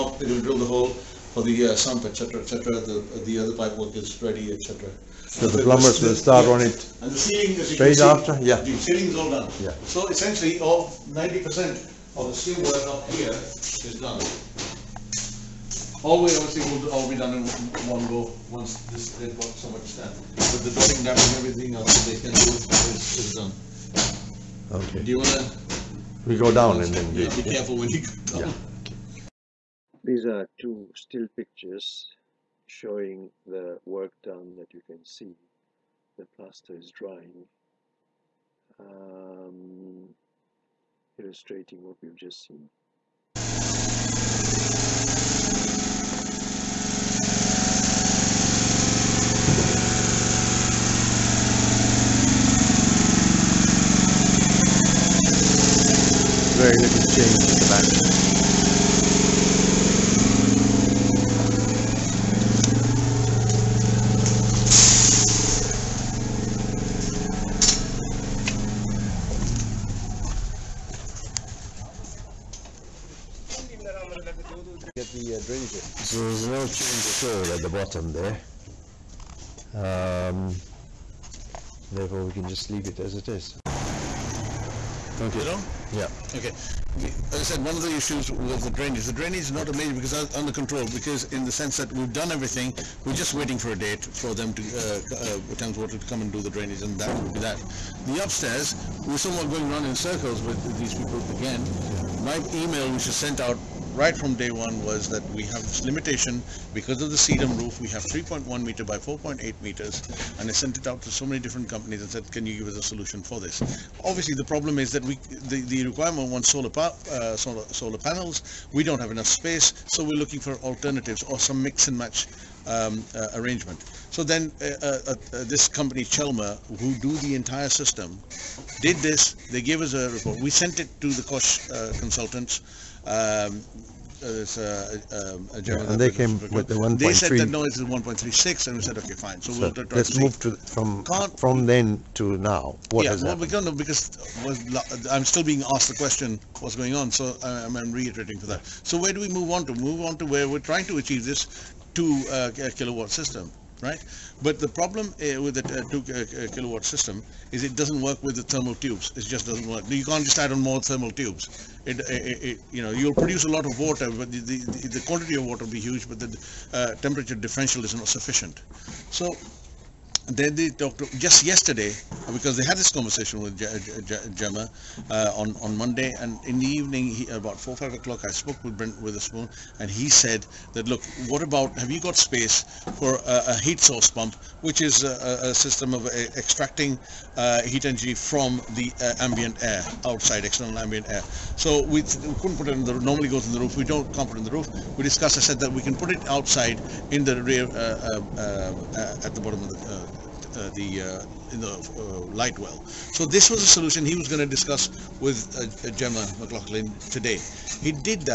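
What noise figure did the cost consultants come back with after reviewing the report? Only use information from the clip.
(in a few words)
1.36.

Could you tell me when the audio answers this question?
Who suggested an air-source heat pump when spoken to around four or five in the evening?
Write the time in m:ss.
2:58.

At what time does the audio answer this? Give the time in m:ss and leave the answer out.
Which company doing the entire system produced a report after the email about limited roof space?
2:06.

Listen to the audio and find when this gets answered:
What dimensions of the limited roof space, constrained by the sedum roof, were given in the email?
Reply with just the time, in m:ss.
1:48.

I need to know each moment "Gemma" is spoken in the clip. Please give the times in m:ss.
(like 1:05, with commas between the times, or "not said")
2:54, 3:25.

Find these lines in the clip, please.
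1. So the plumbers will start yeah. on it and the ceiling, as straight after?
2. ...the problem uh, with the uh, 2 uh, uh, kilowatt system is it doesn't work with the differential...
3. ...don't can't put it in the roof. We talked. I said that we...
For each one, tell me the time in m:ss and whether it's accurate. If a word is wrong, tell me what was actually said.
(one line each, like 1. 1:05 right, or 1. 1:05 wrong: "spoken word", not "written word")
1. 0:05 right
2. 2:34 wrong: "thermal", not "differential"
3. 3:13 wrong: "discussed", not "talked".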